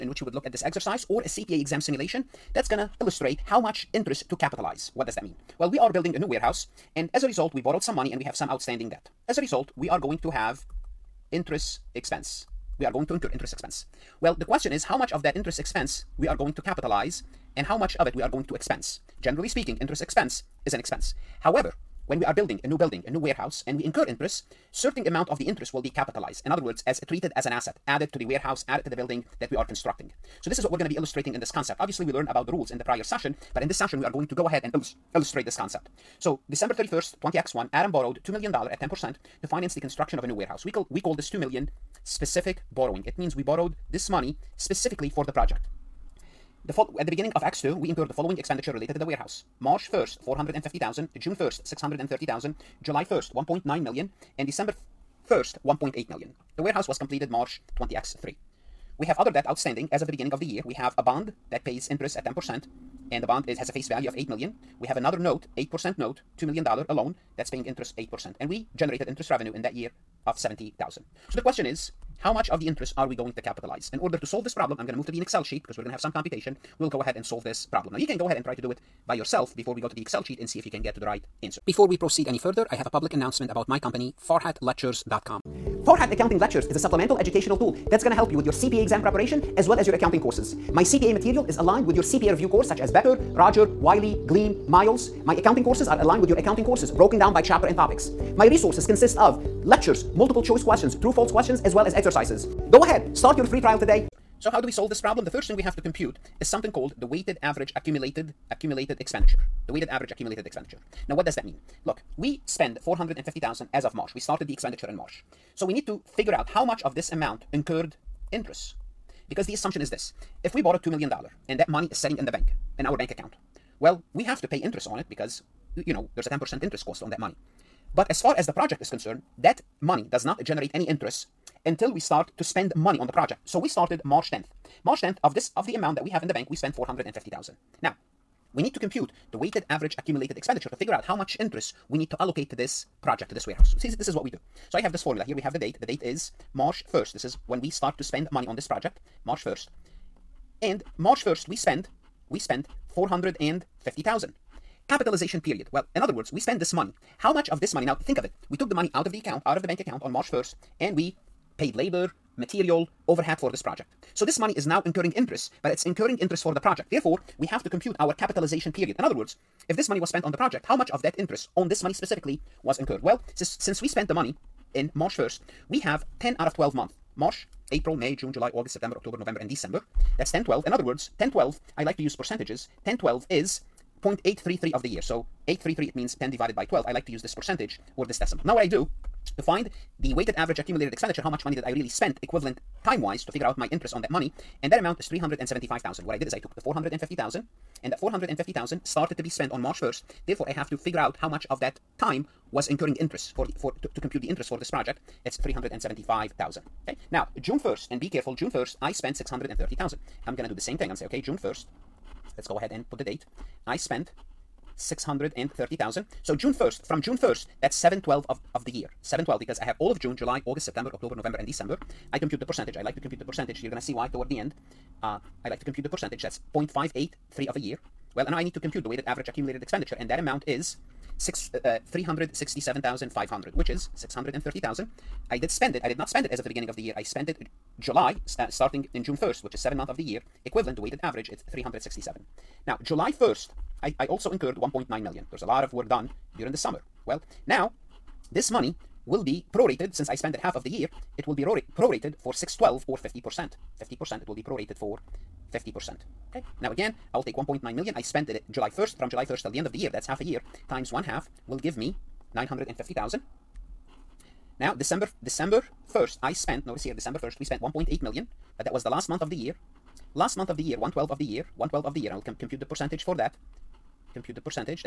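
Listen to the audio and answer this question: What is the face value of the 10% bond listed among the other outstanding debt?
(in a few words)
8 million.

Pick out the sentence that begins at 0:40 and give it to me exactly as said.
We call, we call this $2 million specific borrowing.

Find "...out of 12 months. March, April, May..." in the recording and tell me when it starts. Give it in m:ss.
2:56.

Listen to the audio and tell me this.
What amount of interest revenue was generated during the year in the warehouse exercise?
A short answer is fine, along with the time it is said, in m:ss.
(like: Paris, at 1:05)
70,000, at 1:10.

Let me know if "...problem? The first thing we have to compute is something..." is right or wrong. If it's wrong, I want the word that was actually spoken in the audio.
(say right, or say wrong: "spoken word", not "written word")
right.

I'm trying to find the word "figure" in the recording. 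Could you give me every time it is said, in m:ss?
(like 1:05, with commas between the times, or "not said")
1:56, 2:20, 3:13, 3:20.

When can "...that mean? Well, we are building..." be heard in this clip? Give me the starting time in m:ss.
0:05.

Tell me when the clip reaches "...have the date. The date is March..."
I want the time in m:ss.
2:25.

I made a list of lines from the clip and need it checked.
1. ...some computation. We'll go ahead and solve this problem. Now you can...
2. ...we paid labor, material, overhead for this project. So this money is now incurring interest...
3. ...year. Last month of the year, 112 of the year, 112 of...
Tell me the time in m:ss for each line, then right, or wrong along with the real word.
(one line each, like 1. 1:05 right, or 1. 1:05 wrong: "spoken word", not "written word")
1. 1:15 right
2. 2:40 right
3. 4:29 right.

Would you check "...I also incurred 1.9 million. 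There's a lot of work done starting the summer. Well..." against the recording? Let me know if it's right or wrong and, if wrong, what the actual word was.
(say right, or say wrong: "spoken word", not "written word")
wrong: "during", not "starting".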